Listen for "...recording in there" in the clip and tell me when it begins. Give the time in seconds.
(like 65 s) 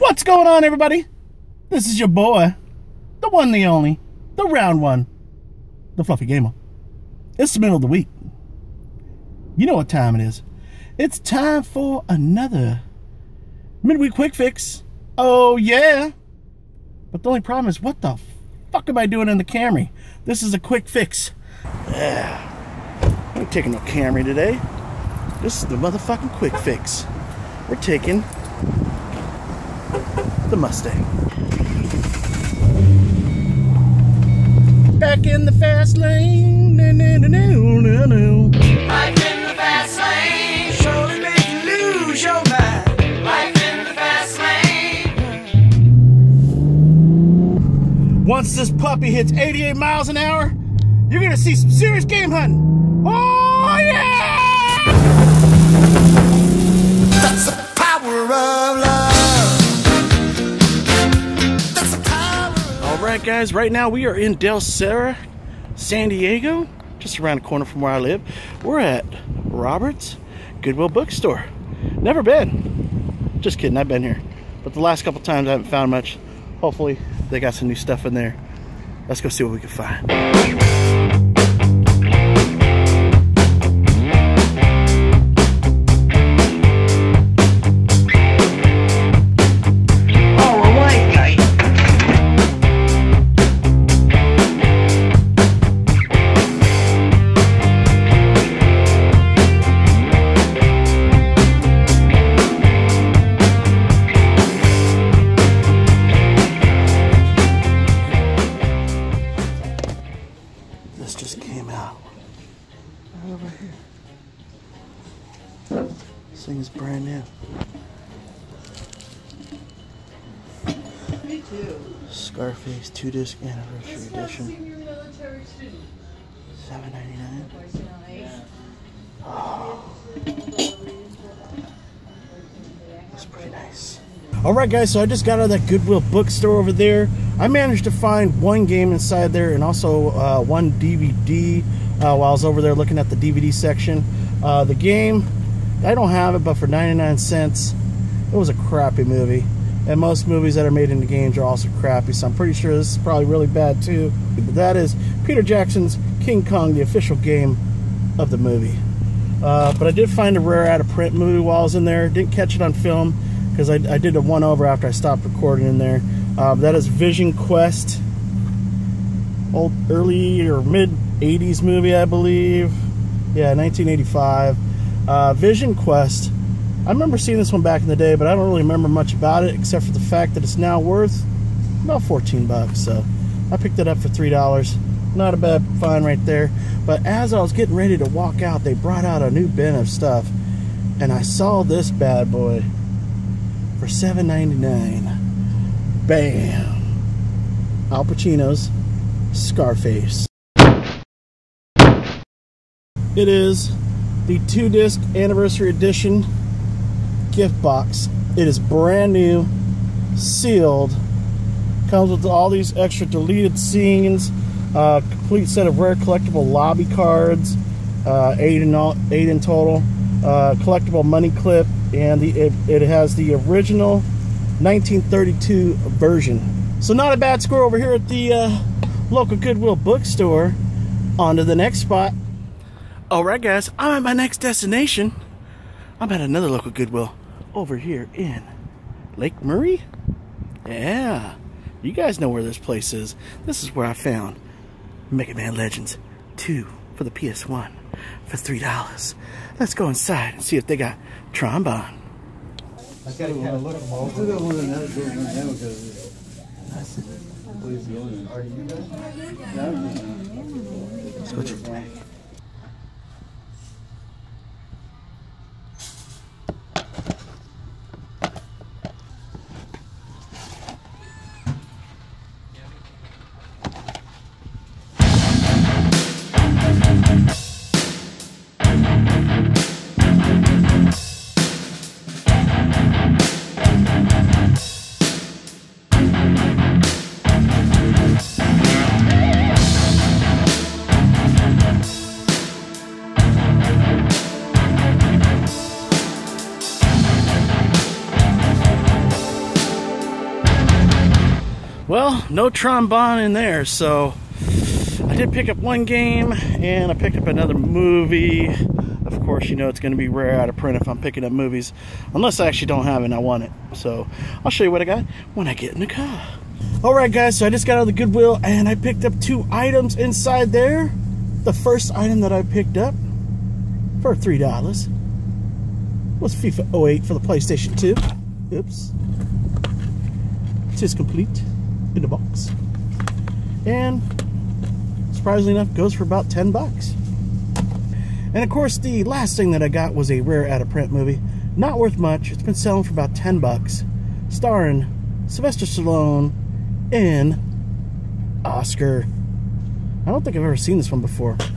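165 s.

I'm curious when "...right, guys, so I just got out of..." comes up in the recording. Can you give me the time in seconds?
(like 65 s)
316 s.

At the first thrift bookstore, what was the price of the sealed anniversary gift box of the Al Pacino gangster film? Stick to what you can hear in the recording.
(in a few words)
$7.99.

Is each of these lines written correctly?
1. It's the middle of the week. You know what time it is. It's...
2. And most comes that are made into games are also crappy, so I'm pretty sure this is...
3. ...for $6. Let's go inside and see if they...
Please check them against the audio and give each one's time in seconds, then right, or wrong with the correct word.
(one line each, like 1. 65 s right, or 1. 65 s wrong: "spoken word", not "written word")
1. 7 s right
2. 149 s wrong: "movies", not "comes"
3. 248 s wrong: "3", not "6".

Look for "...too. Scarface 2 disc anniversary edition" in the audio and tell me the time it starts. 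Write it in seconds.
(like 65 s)
121 s.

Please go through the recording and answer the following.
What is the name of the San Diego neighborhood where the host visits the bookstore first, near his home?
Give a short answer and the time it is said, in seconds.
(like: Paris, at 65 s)
Del Cerro, at 64 s.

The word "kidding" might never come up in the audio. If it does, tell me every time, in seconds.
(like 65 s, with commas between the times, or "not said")
73 s.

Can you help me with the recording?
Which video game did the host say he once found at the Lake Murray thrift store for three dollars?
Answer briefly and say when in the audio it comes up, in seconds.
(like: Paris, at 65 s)
Mega Man Legends 2, at 245 s.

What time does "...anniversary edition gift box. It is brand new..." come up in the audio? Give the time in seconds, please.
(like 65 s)
205 s.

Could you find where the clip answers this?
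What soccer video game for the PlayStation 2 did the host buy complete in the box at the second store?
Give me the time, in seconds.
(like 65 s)
326 s.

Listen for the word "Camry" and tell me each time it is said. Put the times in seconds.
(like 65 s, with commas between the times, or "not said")
19 s, 23 s.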